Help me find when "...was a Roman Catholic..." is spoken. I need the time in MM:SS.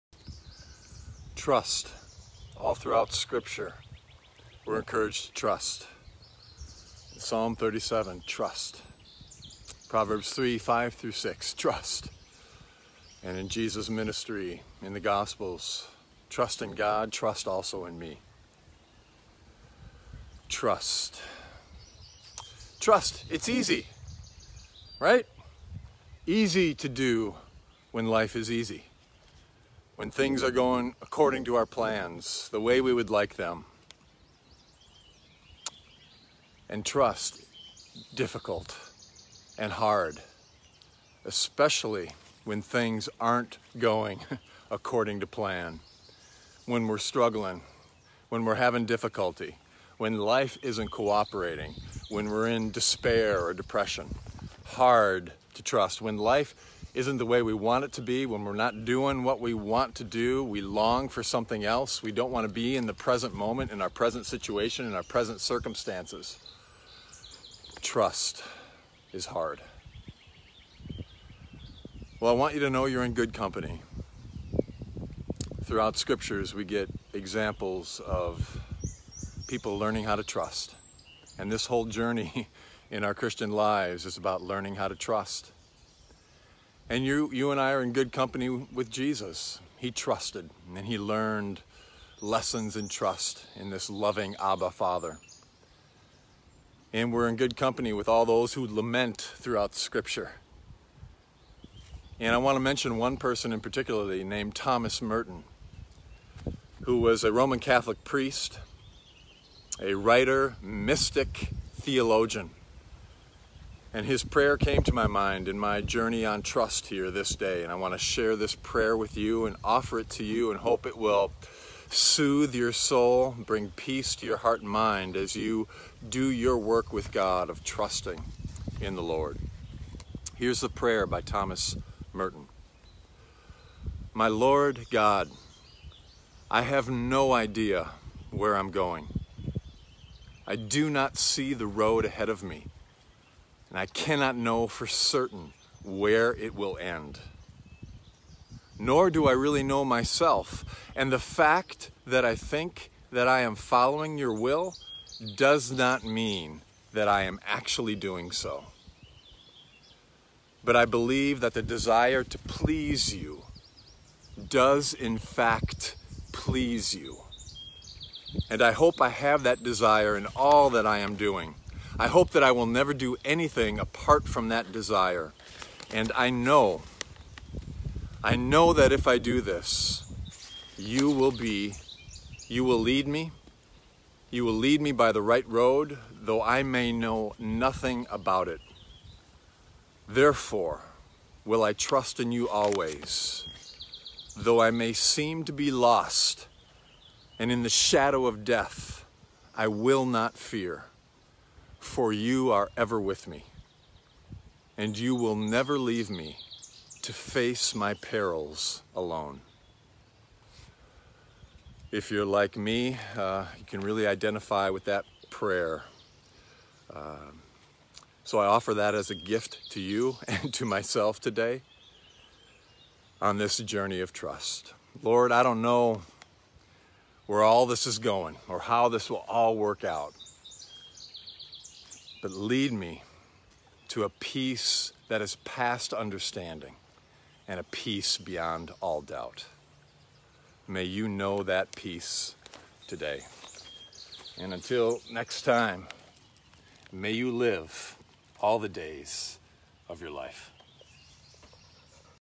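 01:46.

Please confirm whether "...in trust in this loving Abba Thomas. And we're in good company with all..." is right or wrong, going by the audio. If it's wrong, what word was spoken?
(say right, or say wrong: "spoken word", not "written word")
wrong: "Father", not "Thomas".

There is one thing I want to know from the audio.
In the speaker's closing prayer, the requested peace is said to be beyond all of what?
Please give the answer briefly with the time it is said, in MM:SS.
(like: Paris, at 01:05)
Doubt, at 03:59.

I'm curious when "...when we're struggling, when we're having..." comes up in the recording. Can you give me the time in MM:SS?
00:46.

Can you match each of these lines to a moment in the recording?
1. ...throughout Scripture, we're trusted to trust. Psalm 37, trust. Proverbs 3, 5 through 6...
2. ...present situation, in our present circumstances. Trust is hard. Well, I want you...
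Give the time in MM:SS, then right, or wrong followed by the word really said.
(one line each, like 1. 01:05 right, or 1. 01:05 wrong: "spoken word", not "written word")
1. 00:02 wrong: "encouraged", not "trusted"
2. 01:03 right.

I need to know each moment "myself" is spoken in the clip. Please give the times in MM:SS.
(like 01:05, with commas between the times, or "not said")
02:29, 03:40.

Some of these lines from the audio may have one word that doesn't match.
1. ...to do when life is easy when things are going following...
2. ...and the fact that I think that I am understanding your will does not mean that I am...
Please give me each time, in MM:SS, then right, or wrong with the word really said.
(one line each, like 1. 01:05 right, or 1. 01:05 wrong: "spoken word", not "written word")
1. 00:26 wrong: "according", not "following"
2. 02:30 wrong: "following", not "understanding".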